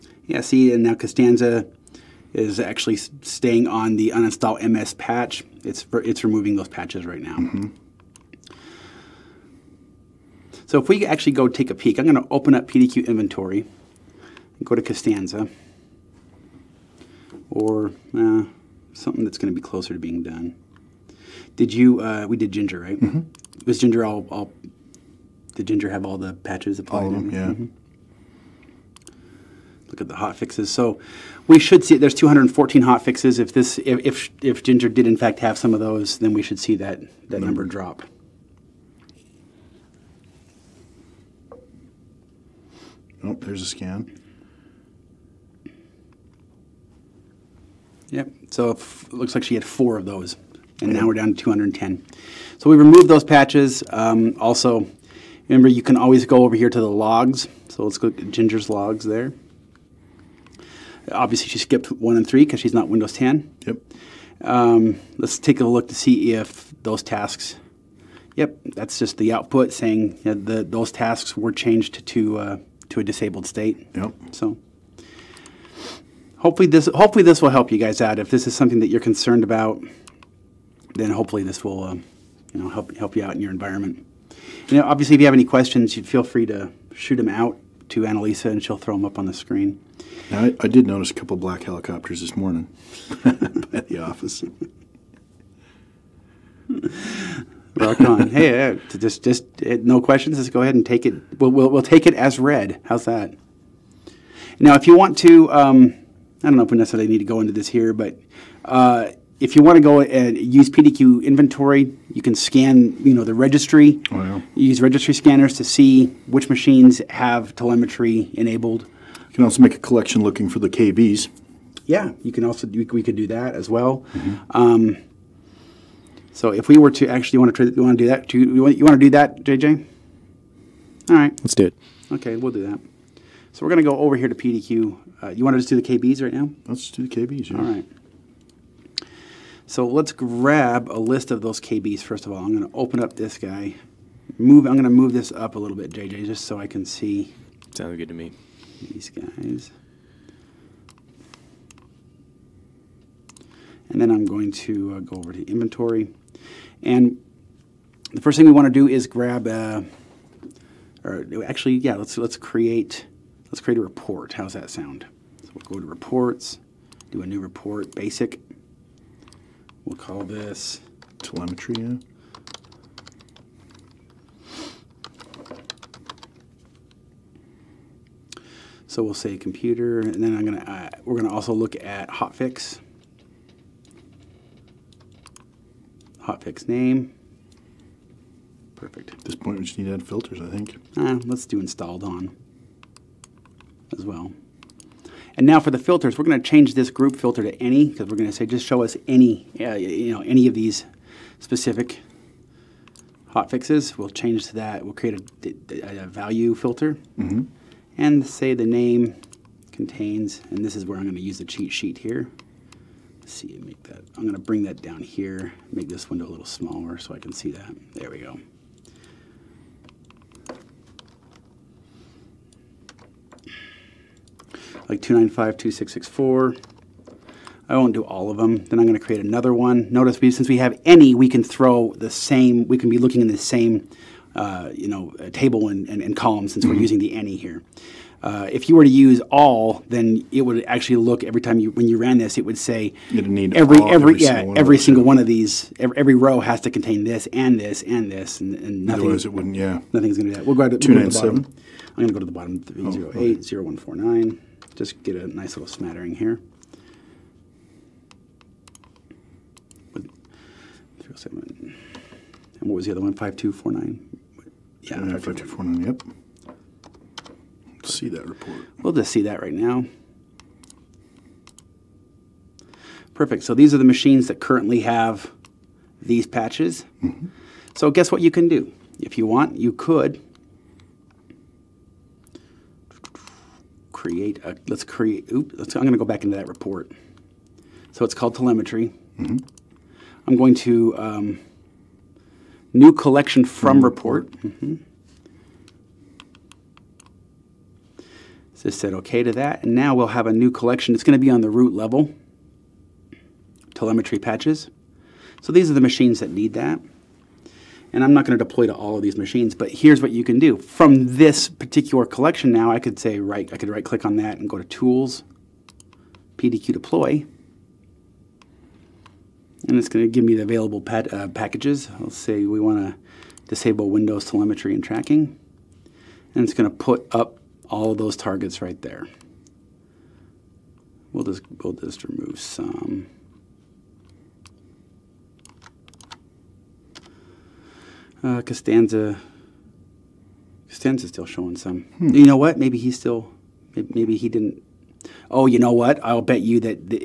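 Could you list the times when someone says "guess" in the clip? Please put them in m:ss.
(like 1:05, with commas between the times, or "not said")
4:37.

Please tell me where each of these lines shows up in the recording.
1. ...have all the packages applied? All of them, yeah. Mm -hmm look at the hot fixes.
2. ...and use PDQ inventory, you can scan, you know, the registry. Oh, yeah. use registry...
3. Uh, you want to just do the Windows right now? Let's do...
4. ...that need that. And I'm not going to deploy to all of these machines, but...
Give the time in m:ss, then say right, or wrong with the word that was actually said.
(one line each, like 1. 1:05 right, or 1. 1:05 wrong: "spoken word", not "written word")
1. 0:25 wrong: "patches", not "packages"
2. 1:50 right
3. 2:15 wrong: "KBs", not "Windows"
4. 5:06 right.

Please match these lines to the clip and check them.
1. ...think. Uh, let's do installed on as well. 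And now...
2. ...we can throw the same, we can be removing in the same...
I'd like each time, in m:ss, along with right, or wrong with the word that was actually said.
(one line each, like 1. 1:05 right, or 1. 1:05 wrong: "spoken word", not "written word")
1. 3:10 right
2. 3:51 wrong: "looking", not "removing".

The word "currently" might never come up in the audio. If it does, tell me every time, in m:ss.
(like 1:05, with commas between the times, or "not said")
4:34.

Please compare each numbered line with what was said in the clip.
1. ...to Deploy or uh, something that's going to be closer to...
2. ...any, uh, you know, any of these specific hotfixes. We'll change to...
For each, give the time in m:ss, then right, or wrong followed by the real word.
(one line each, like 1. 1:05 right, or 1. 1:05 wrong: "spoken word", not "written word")
1. 0:14 wrong: "Costanza", not "Deploy"
2. 3:19 right.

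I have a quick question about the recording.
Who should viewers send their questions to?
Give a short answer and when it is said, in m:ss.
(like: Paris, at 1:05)
Annalisa, at 1:28.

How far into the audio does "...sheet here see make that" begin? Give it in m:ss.
3:31.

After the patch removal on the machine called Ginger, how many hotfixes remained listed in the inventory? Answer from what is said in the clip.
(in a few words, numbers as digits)
210.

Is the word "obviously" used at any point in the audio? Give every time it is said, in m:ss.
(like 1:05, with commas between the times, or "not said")
1:01, 1:24.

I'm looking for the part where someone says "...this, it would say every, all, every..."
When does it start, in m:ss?
4:02.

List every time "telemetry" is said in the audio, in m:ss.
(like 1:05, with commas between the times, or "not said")
1:57, 2:51, 4:48, 5:03, 5:24.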